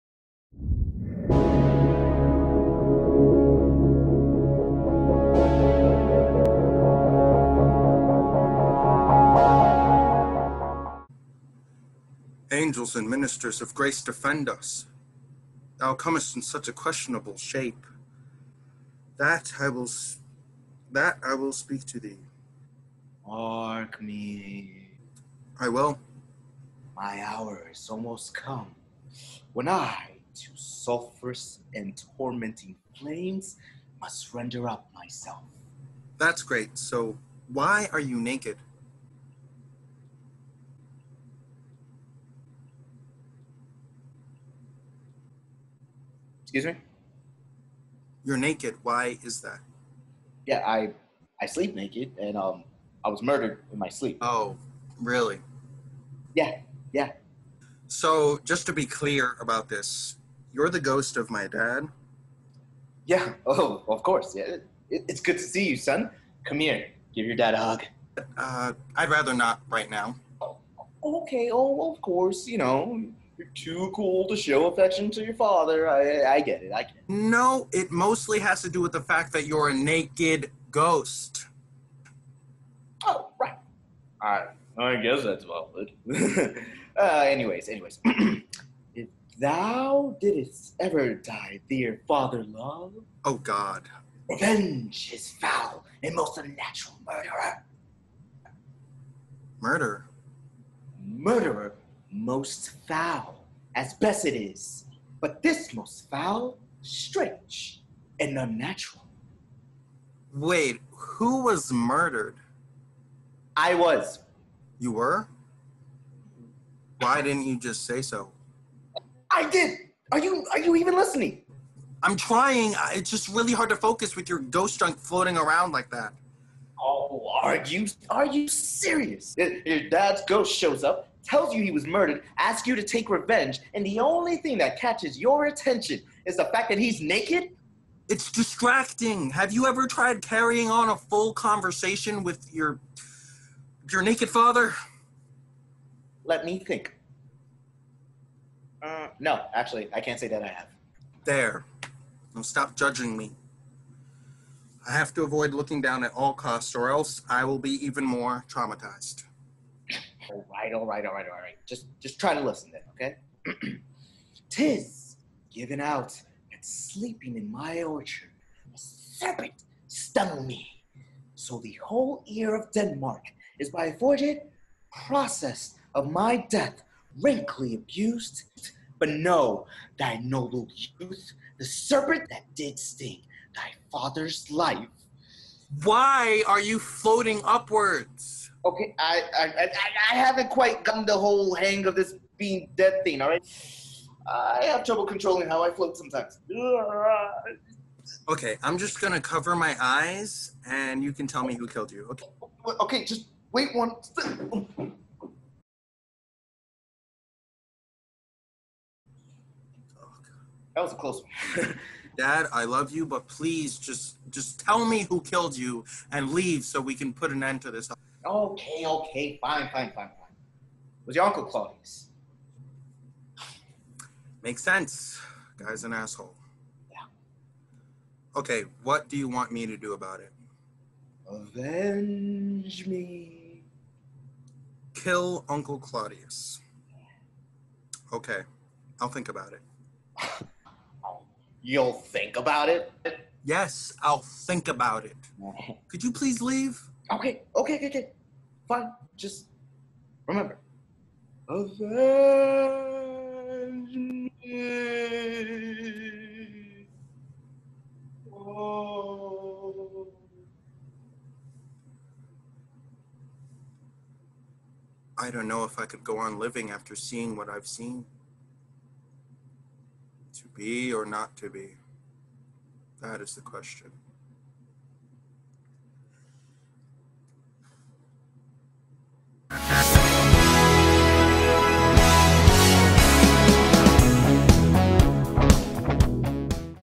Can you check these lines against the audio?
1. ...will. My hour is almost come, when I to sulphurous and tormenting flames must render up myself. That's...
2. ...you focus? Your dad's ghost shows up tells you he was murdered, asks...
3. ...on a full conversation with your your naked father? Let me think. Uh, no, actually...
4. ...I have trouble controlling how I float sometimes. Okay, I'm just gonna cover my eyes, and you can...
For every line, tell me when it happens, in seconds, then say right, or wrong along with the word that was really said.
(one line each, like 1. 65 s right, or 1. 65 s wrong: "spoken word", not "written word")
1. 25 s right
2. 128 s wrong: "serious", not "focus"
3. 140 s right
4. 194 s right.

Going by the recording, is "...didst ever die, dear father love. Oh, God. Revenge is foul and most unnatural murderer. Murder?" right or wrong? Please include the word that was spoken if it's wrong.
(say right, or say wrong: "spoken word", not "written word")
right.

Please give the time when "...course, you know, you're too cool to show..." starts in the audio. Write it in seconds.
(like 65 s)
72 s.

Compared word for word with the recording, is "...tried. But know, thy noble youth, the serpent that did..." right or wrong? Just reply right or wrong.
wrong.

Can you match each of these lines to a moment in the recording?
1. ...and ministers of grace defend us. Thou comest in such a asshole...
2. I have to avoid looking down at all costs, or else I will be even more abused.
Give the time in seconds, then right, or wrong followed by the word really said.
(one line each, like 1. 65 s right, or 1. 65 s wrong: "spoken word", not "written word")
1. 12 s wrong: "questionable", not "asshole"
2. 154 s wrong: "traumatized", not "abused".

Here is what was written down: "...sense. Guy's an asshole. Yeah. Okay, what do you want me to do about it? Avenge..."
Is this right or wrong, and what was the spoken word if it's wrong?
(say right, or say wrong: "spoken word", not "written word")
right.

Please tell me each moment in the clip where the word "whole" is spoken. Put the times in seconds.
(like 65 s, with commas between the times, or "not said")
171 s, 191 s.